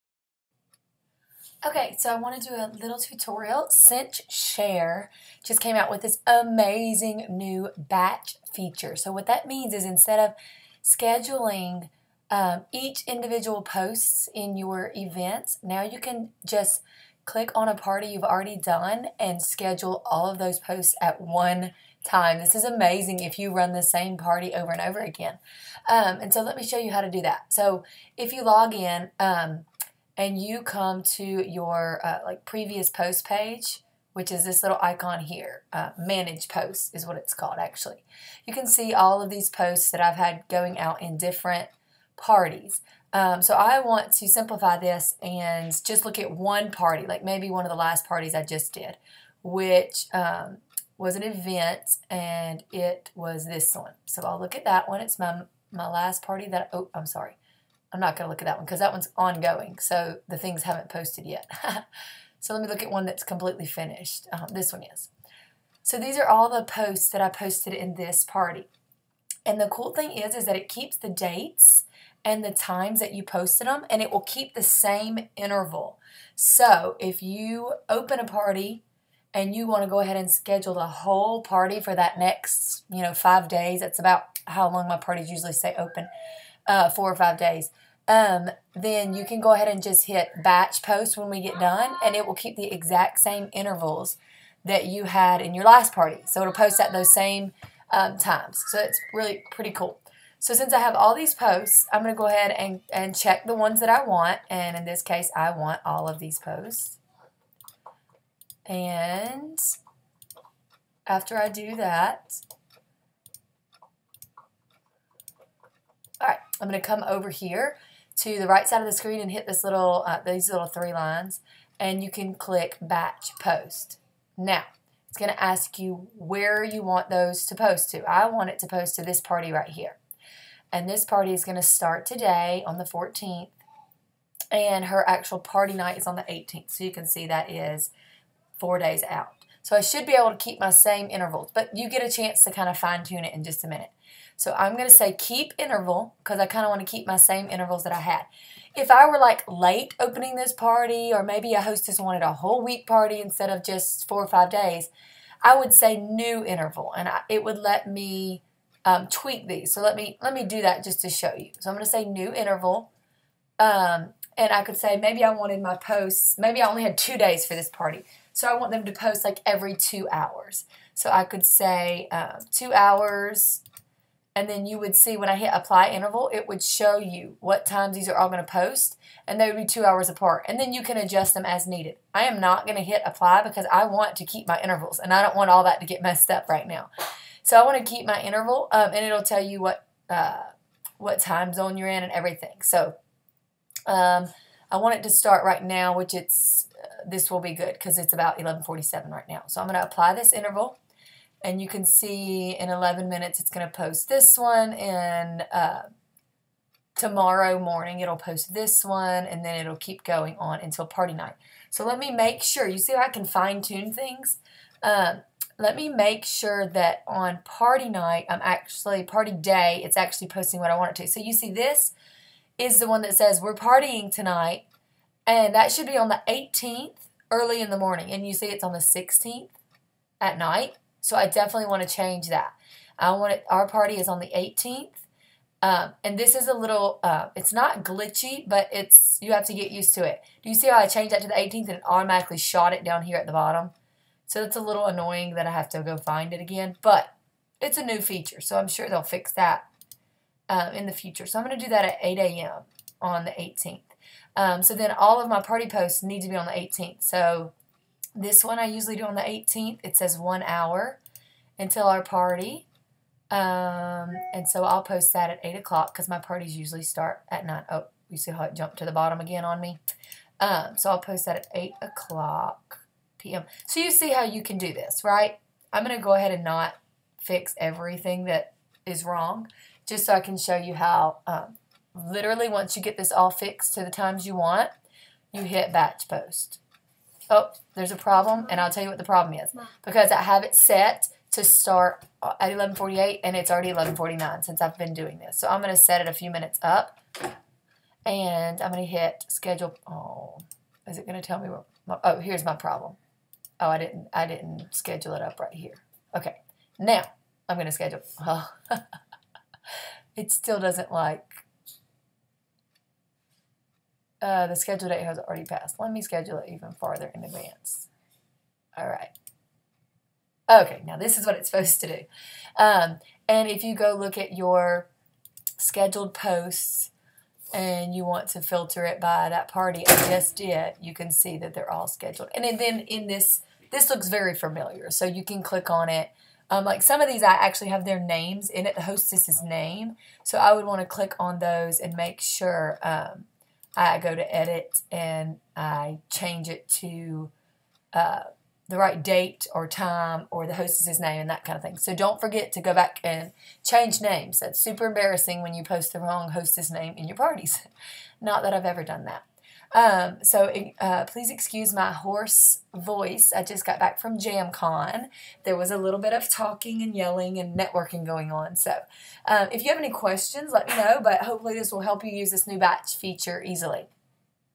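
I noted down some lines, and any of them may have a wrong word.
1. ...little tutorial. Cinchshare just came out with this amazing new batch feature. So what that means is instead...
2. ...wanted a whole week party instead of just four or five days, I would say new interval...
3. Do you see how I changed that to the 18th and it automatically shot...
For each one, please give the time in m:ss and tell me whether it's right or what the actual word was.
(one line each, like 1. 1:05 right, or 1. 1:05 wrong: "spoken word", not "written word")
1. 0:02 right
2. 2:31 right
3. 4:00 right.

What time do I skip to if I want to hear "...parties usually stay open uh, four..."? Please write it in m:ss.
1:24.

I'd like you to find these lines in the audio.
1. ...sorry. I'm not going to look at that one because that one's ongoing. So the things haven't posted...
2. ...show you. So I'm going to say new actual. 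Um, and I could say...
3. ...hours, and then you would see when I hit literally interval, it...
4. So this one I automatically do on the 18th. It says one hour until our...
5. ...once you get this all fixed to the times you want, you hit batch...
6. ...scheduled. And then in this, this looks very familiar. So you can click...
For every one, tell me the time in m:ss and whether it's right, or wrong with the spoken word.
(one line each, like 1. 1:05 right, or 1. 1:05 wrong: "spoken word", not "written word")
1. 0:57 right
2. 2:41 wrong: "interval", not "actual"
3. 2:52 wrong: "apply", not "literally"
4. 4:17 wrong: "usually", not "automatically"
5. 4:42 right
6. 5:31 right.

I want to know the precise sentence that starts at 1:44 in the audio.
And in this case, I want all of these posts.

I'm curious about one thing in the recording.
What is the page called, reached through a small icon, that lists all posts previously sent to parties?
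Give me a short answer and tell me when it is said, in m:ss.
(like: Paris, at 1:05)
Manage posts, at 0:35.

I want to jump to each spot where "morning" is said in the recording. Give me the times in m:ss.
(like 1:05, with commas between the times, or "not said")
3:27, 3:47.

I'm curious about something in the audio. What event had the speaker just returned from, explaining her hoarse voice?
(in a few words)
JamCon.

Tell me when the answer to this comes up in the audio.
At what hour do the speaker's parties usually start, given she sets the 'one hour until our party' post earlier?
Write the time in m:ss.
4:27.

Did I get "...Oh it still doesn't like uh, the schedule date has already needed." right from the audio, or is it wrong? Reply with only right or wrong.
wrong.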